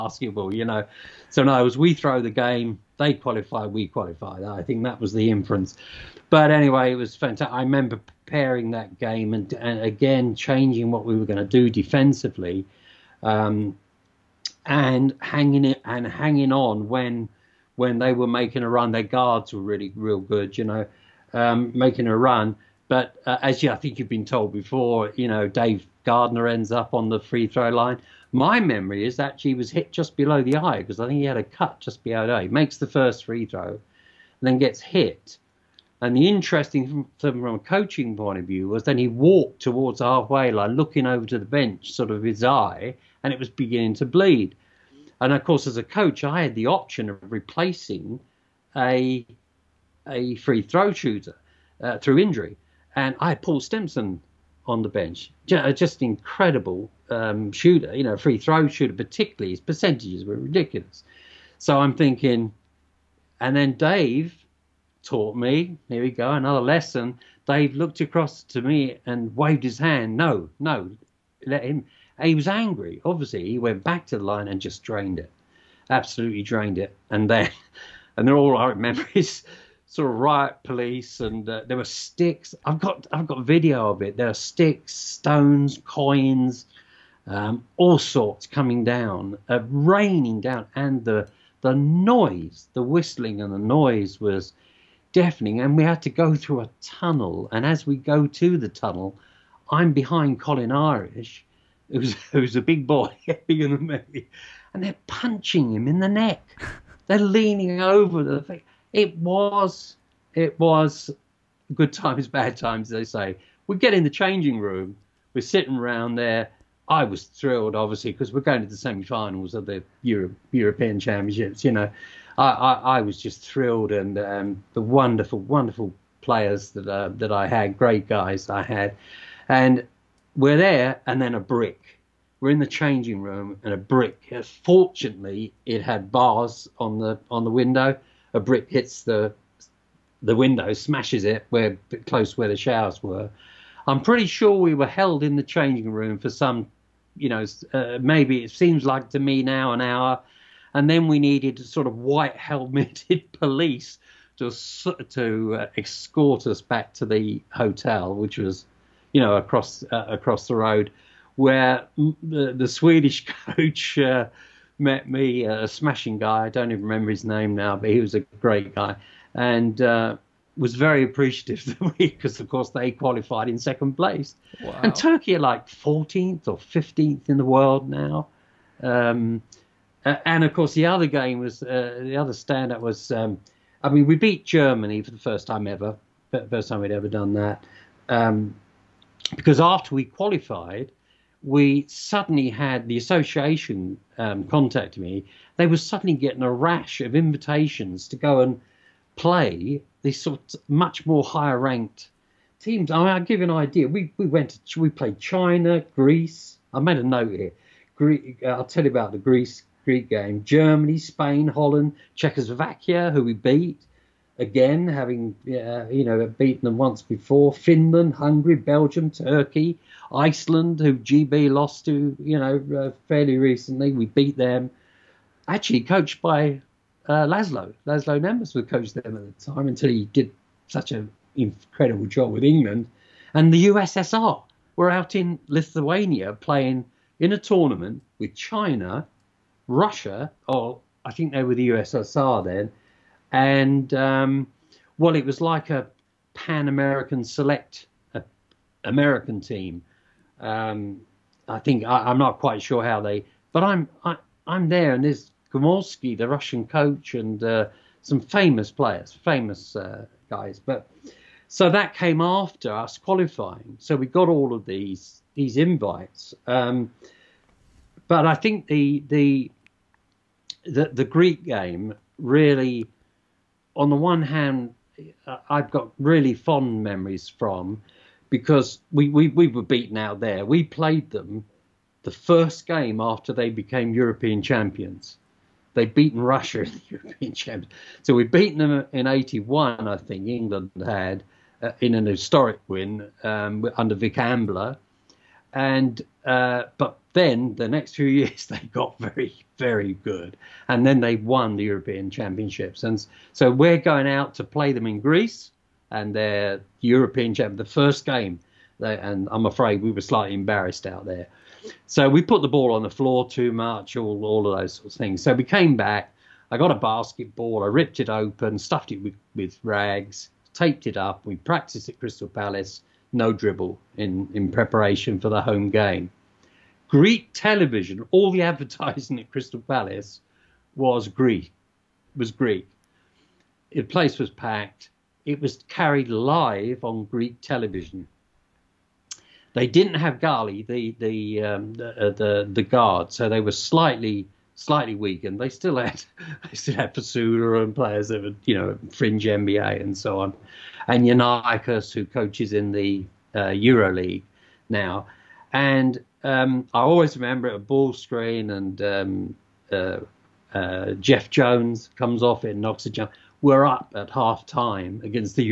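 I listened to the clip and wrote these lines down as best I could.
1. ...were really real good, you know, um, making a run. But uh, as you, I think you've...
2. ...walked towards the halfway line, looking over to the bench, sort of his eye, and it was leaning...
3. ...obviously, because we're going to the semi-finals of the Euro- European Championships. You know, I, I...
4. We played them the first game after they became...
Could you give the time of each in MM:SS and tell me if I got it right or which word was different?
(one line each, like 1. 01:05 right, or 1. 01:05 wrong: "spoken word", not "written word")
1. 00:19 right
2. 00:39 wrong: "beginning", not "leaning"
3. 01:57 right
4. 04:40 right.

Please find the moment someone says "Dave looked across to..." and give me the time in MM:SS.
01:07.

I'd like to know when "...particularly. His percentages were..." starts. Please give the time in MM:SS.
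00:58.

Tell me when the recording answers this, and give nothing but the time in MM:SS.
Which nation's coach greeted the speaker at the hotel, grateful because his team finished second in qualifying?
02:42.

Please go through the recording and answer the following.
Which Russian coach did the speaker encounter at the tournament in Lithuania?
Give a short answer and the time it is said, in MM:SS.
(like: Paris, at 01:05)
Gomelsky, at 04:15.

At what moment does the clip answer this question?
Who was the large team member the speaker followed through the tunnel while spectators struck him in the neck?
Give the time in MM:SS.
01:40.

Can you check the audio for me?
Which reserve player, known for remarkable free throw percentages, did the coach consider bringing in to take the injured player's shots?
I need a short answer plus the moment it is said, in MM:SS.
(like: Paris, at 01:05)
Paul Stimson, at 00:53.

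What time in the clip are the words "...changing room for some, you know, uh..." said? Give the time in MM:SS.
02:25.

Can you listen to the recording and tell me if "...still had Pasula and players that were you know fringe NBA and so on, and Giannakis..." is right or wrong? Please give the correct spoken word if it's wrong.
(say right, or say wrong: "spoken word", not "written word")
right.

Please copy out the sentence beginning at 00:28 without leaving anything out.
My memory is that he was hit just below the eye because I think he had a cut just below the eye.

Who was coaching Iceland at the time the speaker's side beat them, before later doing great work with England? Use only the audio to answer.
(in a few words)
Laszlo Nemes.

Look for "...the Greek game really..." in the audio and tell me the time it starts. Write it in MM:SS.
04:30.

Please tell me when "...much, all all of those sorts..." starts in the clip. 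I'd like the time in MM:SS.
05:13.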